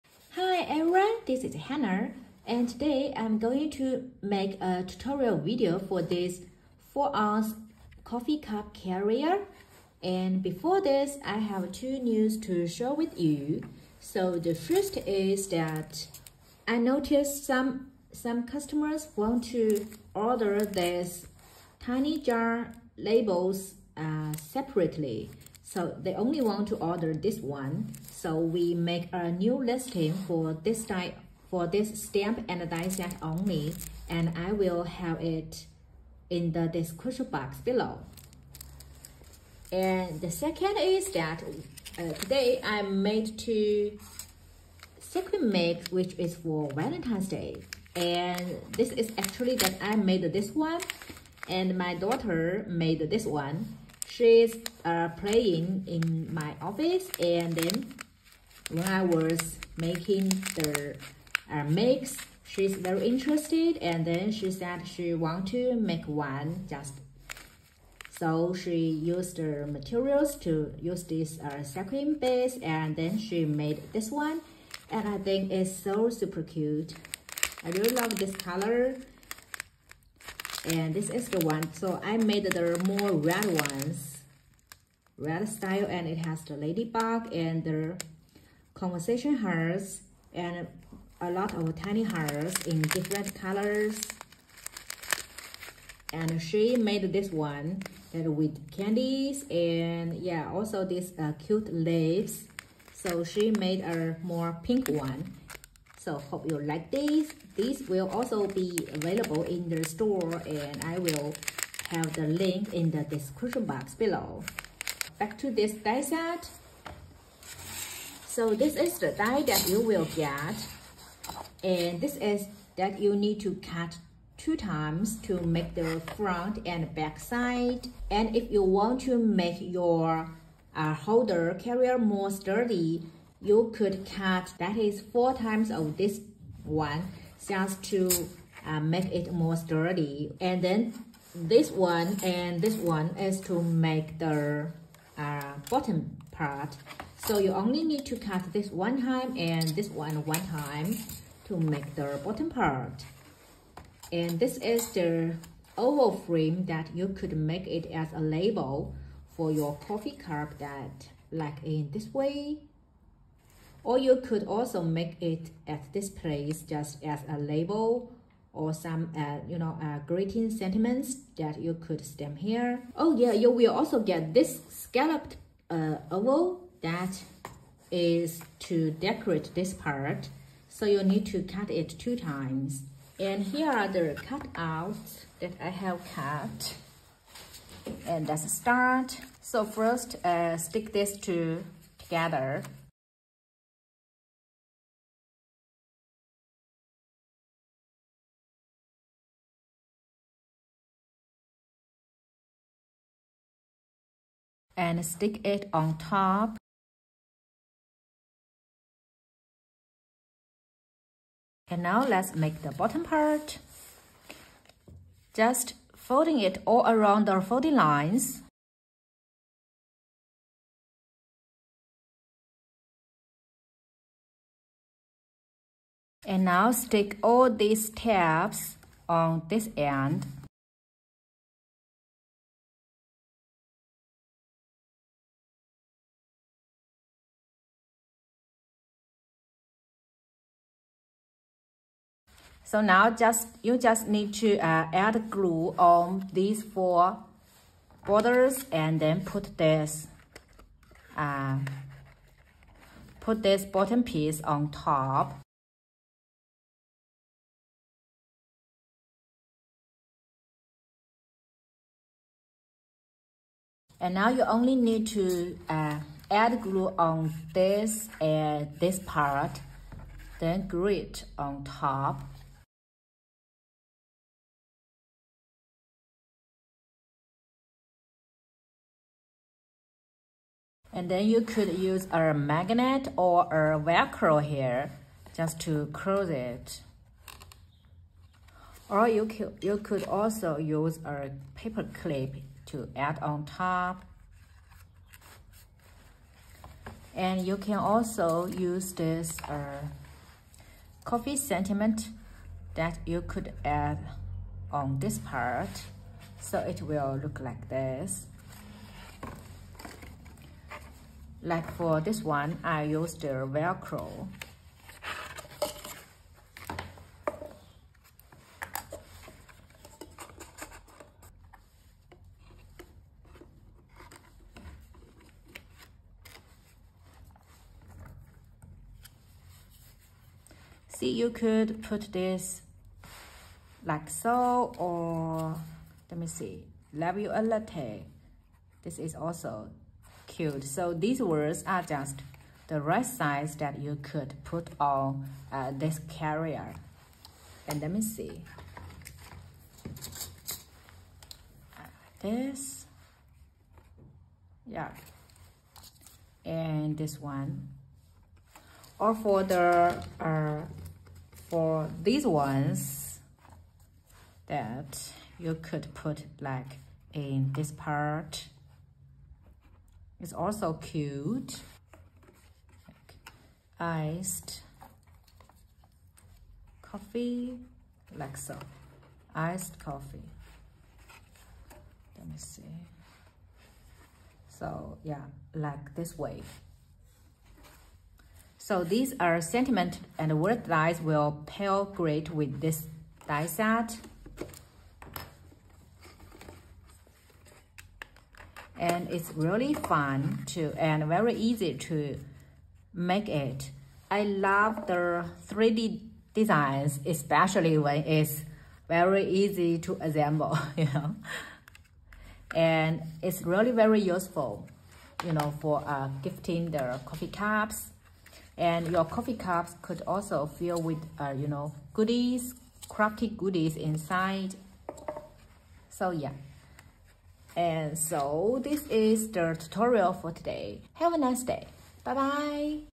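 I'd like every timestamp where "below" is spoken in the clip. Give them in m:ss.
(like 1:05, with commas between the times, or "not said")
0:37, 1:53.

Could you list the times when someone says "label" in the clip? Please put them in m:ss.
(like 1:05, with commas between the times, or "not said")
0:22, 2:38, 2:47.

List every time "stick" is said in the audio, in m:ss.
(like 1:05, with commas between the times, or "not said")
3:10, 3:25, 3:46.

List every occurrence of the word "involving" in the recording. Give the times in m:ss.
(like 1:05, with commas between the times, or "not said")
not said.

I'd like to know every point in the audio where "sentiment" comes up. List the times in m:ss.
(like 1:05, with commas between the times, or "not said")
2:50, 5:01, 6:29.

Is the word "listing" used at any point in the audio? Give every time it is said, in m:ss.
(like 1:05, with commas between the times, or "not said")
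0:29.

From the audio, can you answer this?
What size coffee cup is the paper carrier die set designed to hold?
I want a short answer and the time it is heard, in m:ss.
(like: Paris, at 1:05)
4 ounce, at 0:06.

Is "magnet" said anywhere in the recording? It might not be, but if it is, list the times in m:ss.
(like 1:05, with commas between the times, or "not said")
4:42.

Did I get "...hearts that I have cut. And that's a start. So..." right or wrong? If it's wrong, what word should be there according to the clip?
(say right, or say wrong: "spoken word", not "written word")
wrong: "cutouts", not "hearts".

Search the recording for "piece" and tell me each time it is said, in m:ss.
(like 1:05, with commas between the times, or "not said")
4:14.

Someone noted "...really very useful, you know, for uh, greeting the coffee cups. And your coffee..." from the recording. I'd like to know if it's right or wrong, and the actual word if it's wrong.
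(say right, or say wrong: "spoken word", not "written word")
wrong: "gifting", not "greeting".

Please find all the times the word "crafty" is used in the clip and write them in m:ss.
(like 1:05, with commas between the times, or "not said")
7:02.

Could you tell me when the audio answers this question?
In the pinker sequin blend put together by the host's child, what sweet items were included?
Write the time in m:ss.
1:38.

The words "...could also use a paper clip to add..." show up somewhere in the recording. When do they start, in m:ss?
4:49.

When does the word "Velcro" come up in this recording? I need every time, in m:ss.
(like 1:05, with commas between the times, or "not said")
4:43, 5:13.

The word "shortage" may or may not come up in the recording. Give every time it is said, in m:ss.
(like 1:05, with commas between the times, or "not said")
not said.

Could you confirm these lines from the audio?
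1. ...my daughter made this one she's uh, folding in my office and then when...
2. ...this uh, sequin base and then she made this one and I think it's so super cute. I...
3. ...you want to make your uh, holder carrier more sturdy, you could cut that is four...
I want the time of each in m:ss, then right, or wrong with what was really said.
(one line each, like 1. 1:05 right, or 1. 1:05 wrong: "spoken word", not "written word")
1. 0:51 wrong: "playing", not "folding"
2. 1:11 right
3. 2:08 right.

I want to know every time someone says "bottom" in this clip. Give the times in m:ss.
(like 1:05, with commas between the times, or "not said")
2:25, 2:32, 3:32, 4:13.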